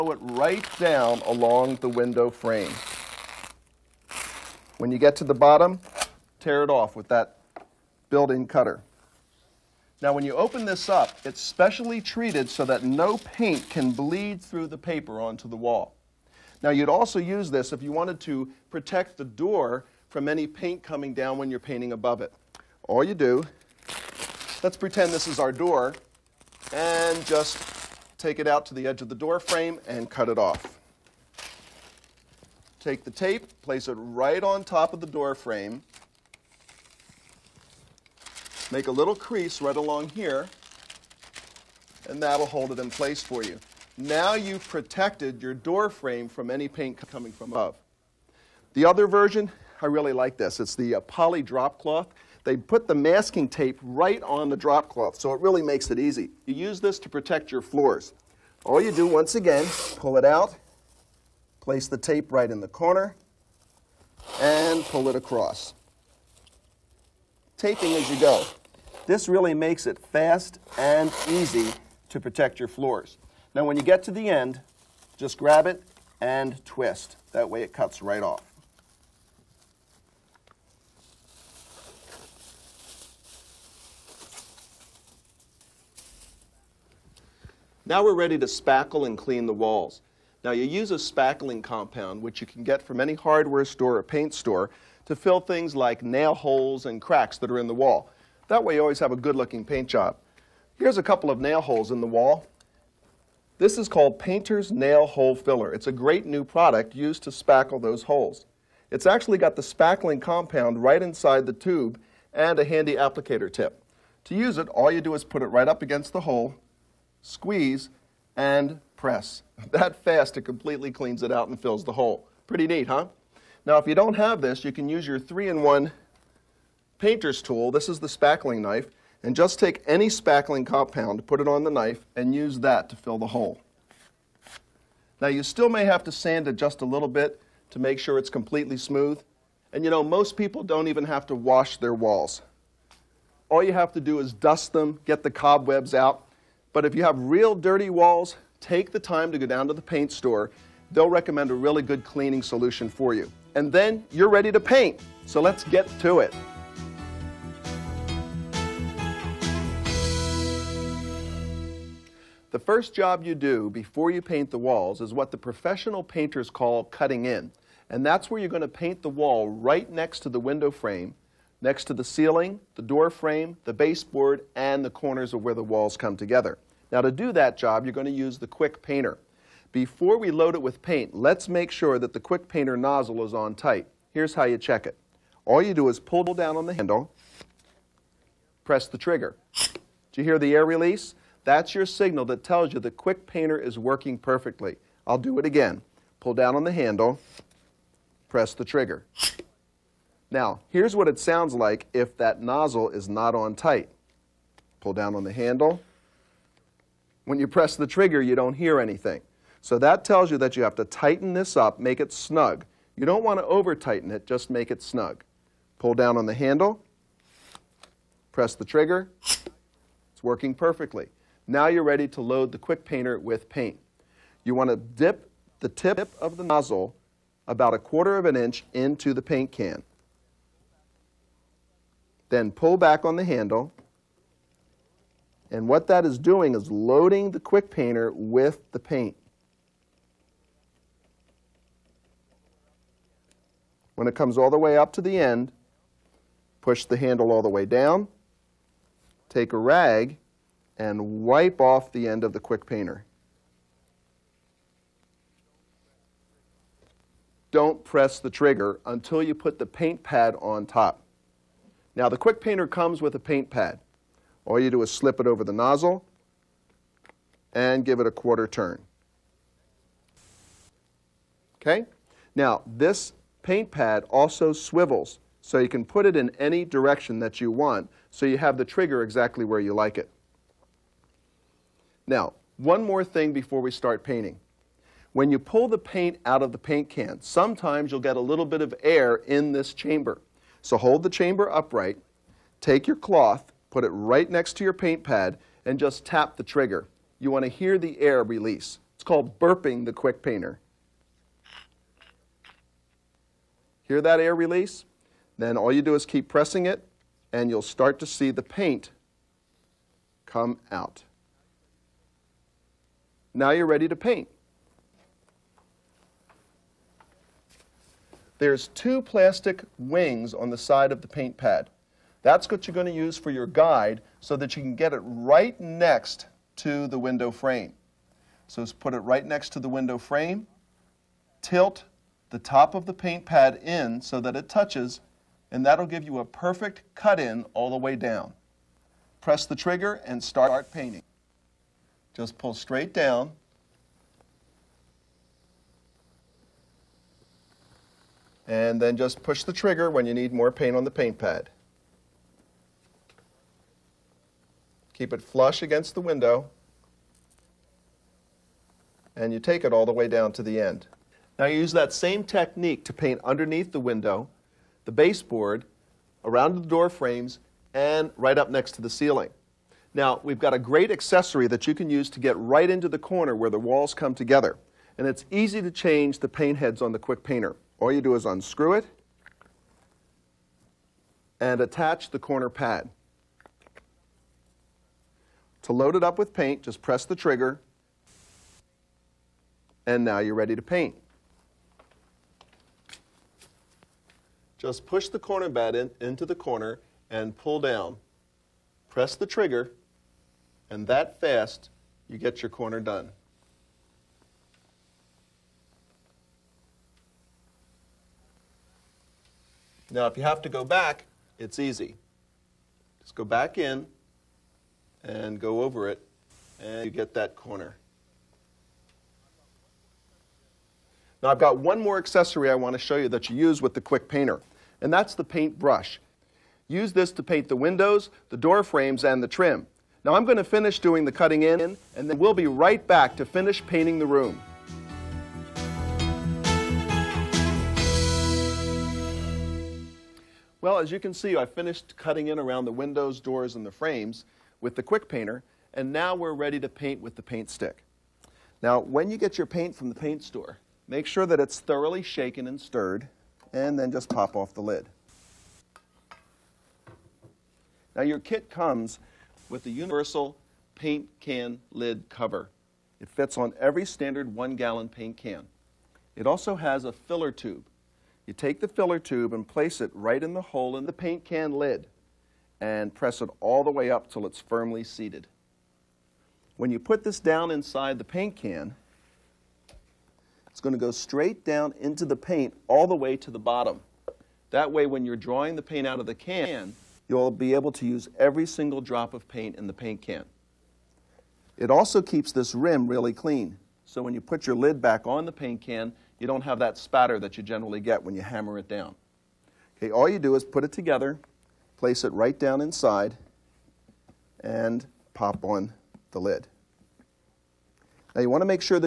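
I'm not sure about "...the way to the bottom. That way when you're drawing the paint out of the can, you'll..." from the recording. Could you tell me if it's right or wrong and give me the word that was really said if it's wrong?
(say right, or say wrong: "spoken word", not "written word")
right.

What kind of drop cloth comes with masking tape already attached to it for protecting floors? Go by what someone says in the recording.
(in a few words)
poly drop cloth.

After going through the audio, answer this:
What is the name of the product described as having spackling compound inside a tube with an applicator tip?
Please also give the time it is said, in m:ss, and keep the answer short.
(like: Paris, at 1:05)
Painter's Nail Hole Filler, at 1:44.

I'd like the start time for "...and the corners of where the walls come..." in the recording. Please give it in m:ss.
2:54.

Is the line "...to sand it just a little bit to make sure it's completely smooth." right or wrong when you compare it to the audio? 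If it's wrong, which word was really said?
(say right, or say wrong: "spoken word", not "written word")
right.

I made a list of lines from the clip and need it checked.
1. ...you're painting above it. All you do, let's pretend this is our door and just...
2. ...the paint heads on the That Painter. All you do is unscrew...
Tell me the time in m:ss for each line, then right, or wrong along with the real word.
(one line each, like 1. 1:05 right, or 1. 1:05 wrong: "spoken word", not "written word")
1. 0:21 right
2. 6:16 wrong: "Quick", not "That".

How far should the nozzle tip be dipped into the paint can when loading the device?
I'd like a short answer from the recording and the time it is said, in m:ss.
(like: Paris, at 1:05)
a quarter of an inch, at 3:47.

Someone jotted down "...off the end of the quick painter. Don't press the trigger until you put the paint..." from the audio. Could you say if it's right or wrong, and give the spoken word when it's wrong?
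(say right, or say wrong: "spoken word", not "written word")
right.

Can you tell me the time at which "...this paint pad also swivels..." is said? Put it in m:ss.
4:32.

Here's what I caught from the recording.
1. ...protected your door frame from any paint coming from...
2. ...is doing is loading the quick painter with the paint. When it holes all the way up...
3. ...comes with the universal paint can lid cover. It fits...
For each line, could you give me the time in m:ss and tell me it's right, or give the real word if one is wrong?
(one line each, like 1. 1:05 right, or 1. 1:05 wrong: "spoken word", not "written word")
1. 0:44 right
2. 3:56 wrong: "comes", not "holes"
3. 7:38 right.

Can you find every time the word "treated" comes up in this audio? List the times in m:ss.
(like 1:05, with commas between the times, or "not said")
0:12.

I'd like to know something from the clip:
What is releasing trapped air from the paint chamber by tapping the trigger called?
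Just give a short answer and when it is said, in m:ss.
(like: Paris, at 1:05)
burping the quick painter, at 4:59.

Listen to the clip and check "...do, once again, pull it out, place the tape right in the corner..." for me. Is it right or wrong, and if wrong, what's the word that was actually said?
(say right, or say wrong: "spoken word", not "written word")
right.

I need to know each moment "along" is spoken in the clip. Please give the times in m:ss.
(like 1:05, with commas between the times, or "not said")
0:01, 0:39.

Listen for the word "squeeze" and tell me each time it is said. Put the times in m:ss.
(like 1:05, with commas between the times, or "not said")
1:57.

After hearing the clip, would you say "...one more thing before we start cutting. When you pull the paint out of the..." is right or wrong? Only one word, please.
wrong.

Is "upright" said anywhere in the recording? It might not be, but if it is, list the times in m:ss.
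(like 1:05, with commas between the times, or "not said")
4:51.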